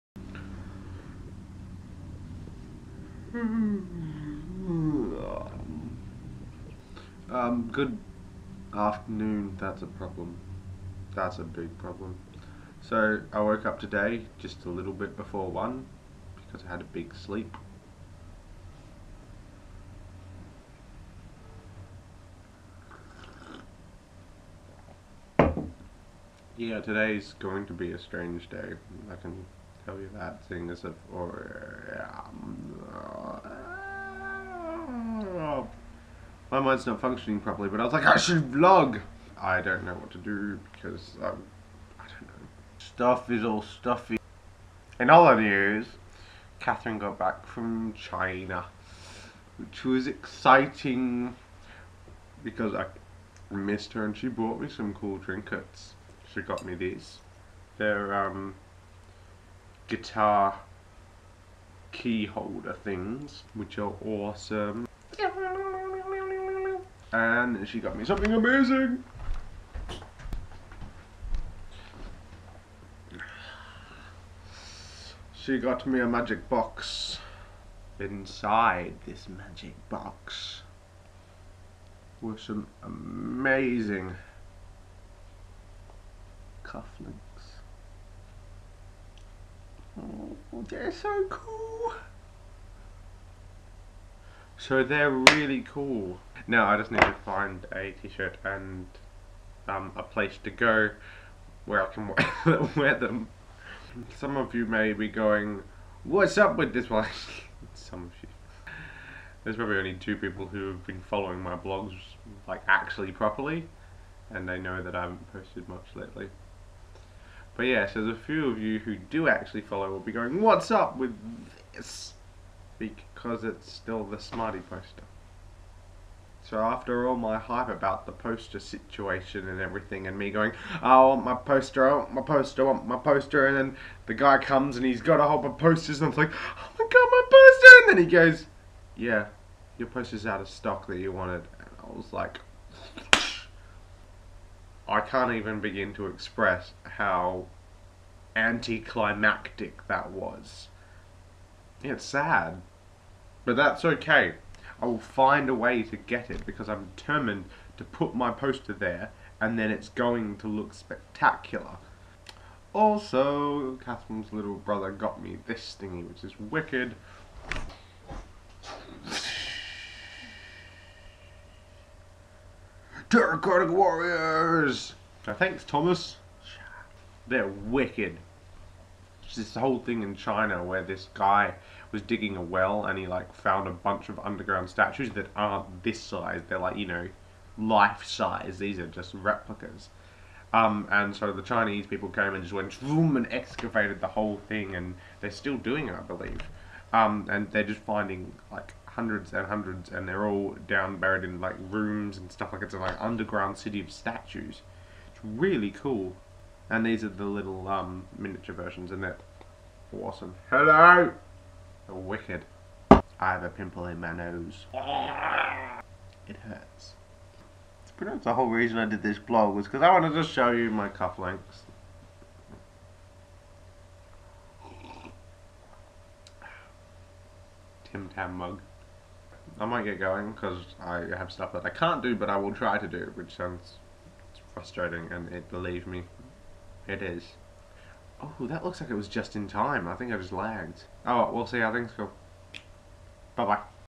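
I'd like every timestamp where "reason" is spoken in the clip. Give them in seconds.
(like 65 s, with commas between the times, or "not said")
218 s.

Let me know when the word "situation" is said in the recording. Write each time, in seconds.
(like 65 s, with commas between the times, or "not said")
128 s.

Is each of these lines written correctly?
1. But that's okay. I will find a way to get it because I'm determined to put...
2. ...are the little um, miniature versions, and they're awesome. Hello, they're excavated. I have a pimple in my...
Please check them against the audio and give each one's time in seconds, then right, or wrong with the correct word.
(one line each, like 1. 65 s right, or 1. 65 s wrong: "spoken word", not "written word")
1. 153 s right
2. 207 s wrong: "wicked", not "excavated".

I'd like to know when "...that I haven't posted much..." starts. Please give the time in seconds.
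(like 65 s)
114 s.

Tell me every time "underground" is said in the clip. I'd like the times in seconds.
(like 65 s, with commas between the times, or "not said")
184 s, 202 s.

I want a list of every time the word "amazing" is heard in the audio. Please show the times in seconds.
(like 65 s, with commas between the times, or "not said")
68 s, 82 s.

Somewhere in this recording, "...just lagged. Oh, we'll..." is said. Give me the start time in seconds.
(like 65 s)
240 s.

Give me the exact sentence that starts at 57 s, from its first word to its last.
They're um guitar key holder things, which are awesome.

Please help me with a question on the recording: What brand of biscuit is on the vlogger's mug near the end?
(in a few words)
Tim Tam.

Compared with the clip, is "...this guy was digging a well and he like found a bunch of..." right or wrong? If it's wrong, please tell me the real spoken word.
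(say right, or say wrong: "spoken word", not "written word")
right.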